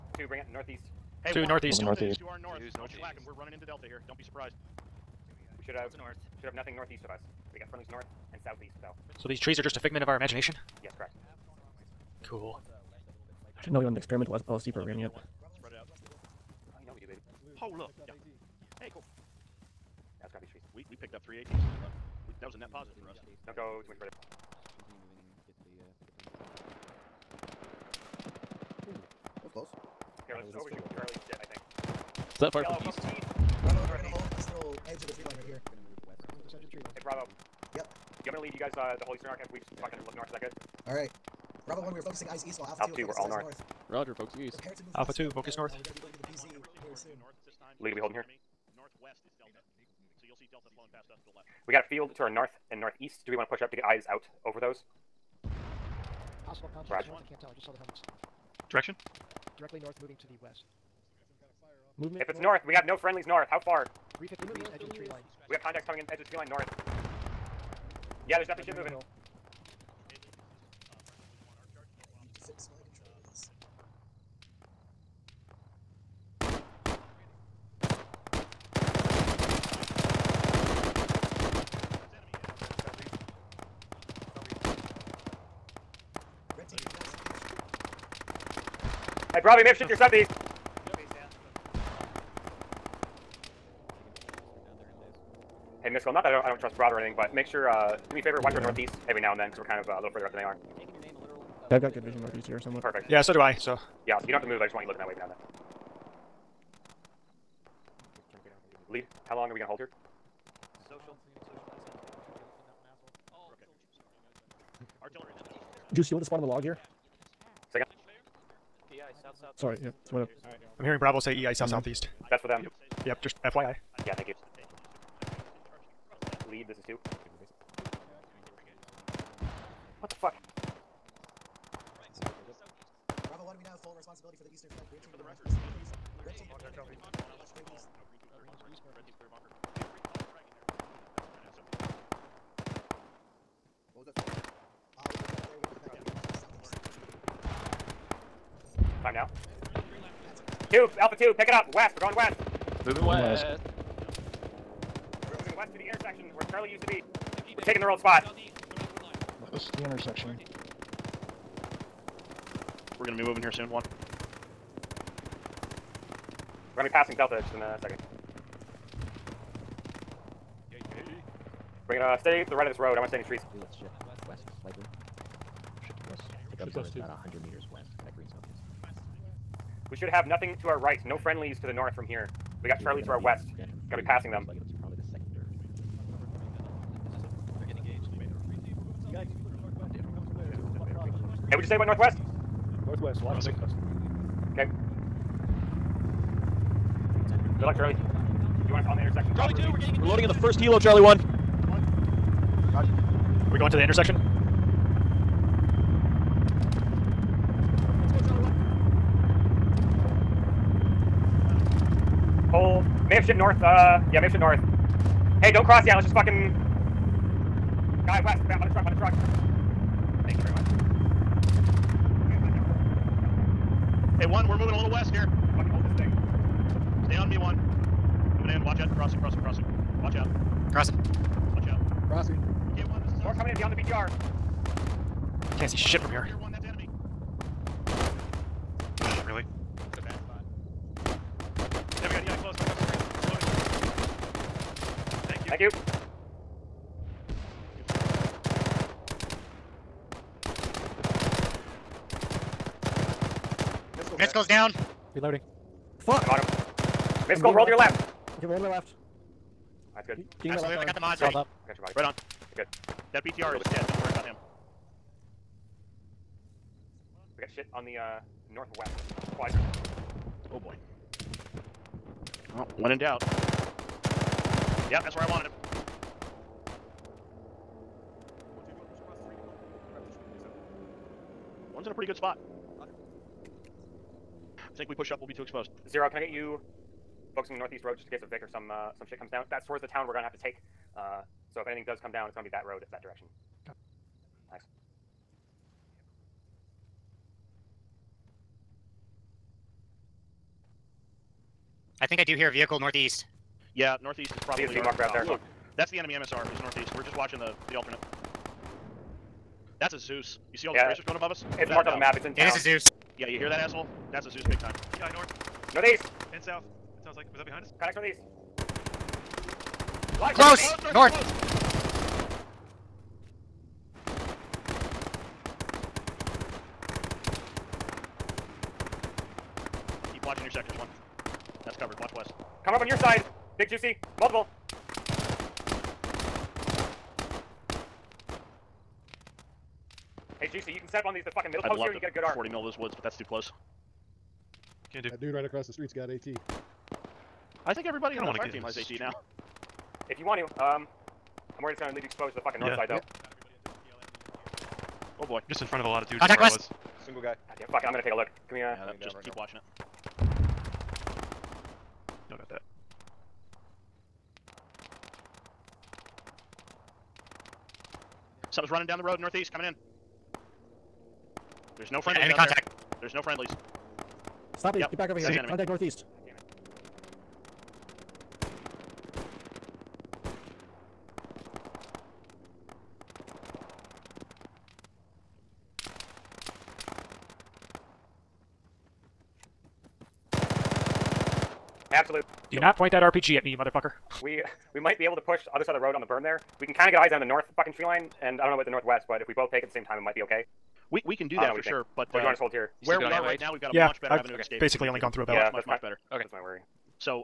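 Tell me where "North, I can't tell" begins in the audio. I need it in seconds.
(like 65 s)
57 s.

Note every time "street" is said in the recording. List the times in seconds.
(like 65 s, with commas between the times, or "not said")
345 s.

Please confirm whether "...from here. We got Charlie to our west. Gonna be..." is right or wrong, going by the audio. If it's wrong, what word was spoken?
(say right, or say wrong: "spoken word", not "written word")
right.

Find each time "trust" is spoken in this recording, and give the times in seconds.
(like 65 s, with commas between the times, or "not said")
96 s.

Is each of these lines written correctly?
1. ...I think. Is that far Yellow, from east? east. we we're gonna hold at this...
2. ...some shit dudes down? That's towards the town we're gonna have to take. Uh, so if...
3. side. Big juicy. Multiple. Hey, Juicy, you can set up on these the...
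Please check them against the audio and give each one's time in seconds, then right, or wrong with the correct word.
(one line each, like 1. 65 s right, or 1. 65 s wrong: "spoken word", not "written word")
1. 31 s right
2. 288 s wrong: "comes", not "dudes"
3. 333 s right.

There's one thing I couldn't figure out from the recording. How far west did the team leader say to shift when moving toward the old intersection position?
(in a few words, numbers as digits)
100 meters.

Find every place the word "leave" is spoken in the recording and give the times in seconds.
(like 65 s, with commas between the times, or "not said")
38 s, 351 s.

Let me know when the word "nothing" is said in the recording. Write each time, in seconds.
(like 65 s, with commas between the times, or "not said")
6 s, 180 s.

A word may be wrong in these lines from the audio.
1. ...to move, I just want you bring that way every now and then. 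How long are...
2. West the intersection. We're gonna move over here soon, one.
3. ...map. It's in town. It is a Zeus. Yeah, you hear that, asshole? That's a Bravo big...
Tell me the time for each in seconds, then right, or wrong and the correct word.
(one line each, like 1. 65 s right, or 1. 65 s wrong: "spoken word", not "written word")
1. 104 s wrong: "looking", not "bring"
2. 159 s right
3. 311 s wrong: "Zeus", not "Bravo".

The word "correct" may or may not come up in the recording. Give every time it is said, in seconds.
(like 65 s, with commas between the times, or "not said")
10 s.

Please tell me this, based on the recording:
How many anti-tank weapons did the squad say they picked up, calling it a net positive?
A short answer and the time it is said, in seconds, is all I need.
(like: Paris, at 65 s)
3, at 21 s.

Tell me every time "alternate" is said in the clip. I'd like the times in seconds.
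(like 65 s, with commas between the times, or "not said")
307 s.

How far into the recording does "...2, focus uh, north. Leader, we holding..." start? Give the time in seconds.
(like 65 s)
45 s.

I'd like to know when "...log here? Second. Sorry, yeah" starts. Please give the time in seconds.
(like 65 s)
116 s.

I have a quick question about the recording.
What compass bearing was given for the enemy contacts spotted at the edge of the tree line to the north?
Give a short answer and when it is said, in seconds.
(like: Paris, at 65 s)
350 degrees, at 64 s.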